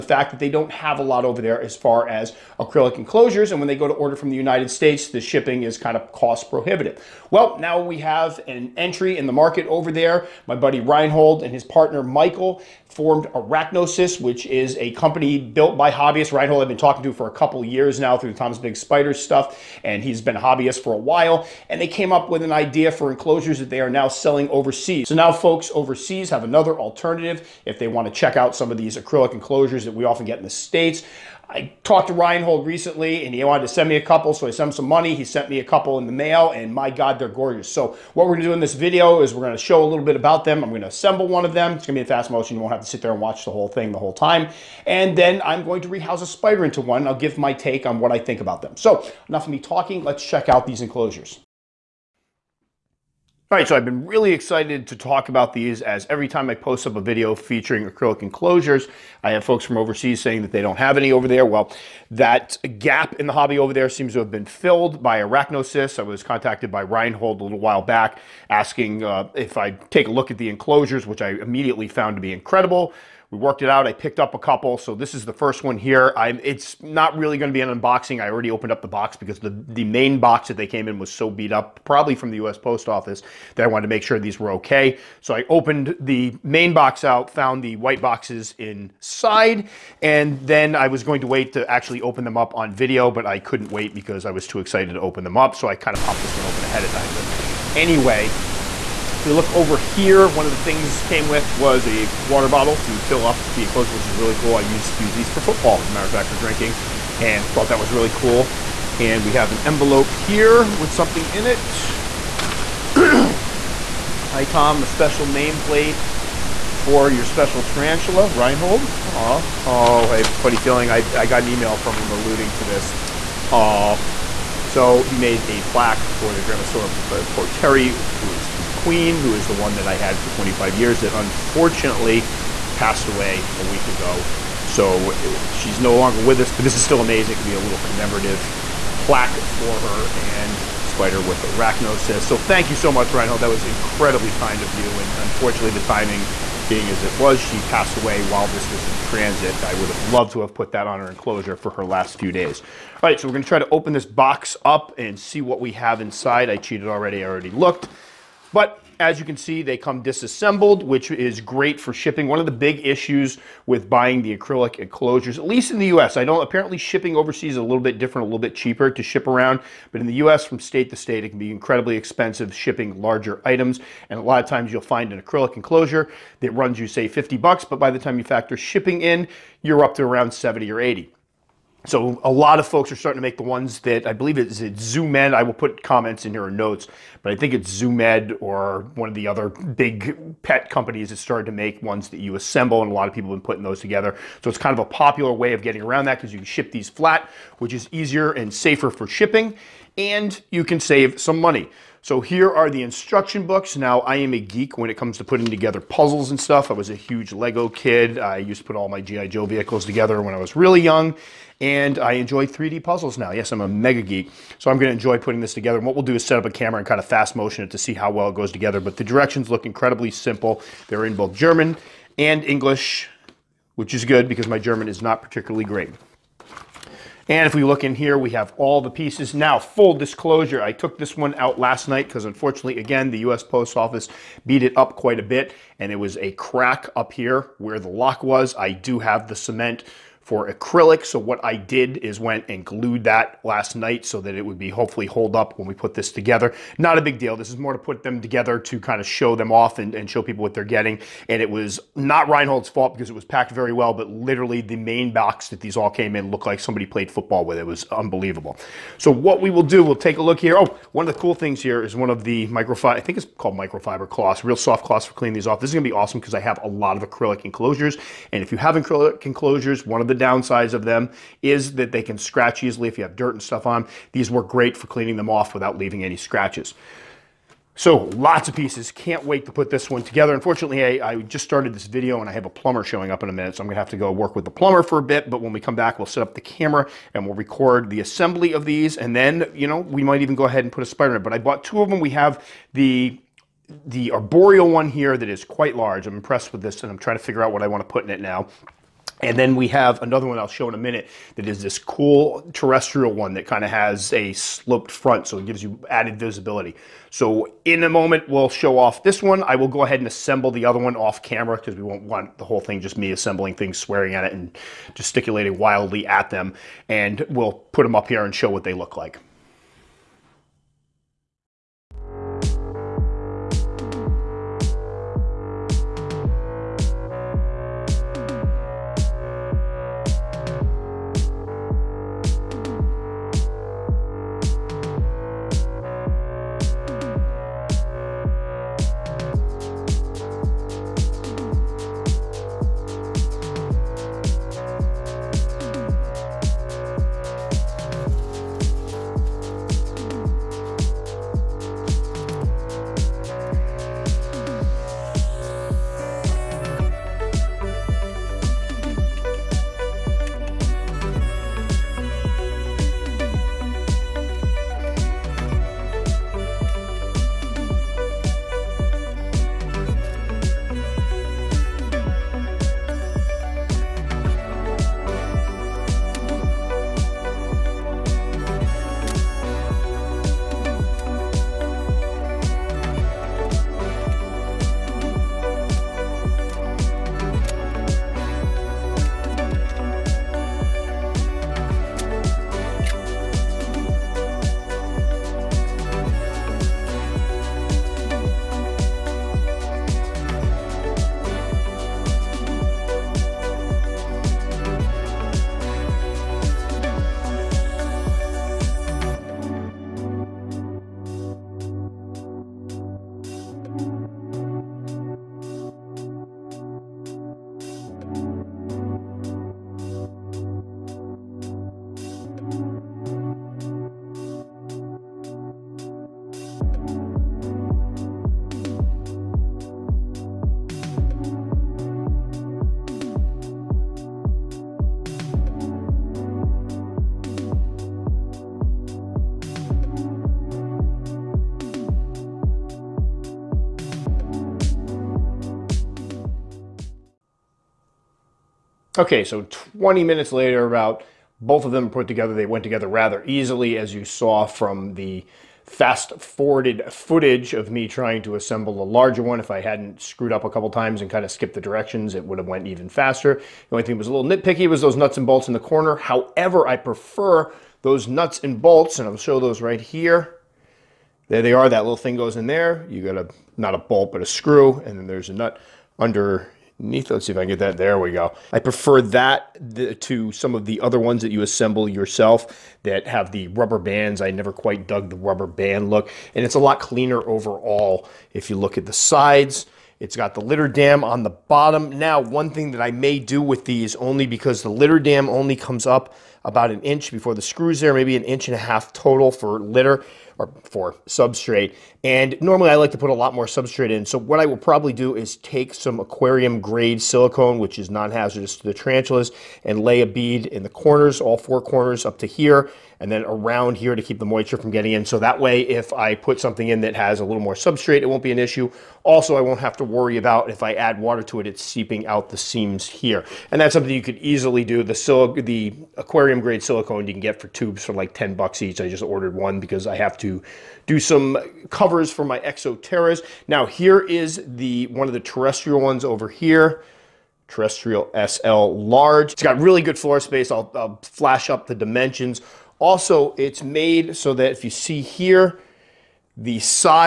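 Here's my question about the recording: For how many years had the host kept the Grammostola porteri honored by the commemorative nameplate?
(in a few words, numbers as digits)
25.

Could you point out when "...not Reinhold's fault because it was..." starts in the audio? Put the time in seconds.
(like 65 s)
251 s.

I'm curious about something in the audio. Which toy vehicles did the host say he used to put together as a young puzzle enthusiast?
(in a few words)
G.I. Joe vehicles.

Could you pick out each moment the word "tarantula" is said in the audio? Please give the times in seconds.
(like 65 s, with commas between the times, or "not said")
117 s, 508 s.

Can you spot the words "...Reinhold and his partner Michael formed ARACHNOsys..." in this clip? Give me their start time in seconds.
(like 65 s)
10 s.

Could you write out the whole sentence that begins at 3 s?
And when they go to order from the United States, the shipping is kind of cost prohibitive.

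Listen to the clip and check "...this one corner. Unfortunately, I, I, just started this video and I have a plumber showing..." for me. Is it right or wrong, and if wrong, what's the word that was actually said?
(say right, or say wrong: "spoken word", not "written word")
wrong: "together", not "corner".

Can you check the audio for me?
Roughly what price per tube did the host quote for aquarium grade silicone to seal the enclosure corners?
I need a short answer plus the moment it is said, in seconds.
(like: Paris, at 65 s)
$10, at 528 s.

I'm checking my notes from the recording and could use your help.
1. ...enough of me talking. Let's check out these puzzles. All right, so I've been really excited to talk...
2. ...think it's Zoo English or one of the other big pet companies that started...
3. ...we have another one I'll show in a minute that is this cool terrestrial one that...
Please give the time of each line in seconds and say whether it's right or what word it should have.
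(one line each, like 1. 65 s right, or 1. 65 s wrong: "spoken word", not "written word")
1. 49 s wrong: "enclosures", not "puzzles"
2. 187 s wrong: "Med", not "English"
3. 299 s right.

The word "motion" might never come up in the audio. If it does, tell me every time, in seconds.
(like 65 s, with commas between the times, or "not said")
42 s, 217 s.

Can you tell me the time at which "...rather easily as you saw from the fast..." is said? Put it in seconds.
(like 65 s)
452 s.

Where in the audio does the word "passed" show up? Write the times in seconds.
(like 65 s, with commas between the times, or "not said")
132 s, 147 s.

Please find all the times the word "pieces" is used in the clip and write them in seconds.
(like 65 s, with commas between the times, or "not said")
228 s, 278 s.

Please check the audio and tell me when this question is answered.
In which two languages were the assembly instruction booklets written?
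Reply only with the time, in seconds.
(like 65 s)
221 s.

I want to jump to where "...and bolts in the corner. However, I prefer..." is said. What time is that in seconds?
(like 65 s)
465 s.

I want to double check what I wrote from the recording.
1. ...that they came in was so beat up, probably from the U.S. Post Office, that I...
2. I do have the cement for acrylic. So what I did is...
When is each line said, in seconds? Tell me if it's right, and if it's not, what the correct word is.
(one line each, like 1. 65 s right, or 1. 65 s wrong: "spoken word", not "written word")
1. 80 s right
2. 238 s right.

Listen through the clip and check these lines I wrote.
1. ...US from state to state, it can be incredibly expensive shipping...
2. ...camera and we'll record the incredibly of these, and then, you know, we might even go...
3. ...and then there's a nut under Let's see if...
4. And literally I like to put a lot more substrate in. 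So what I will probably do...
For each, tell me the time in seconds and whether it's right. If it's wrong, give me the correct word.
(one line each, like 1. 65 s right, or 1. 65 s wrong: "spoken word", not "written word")
1. 170 s right
2. 286 s wrong: "assembly", not "incredibly"
3. 474 s right
4. 502 s wrong: "normally", not "literally".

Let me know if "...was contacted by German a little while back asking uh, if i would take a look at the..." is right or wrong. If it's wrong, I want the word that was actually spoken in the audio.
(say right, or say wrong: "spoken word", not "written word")
wrong: "Reinhold", not "German".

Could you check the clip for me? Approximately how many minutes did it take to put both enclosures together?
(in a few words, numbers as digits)
20.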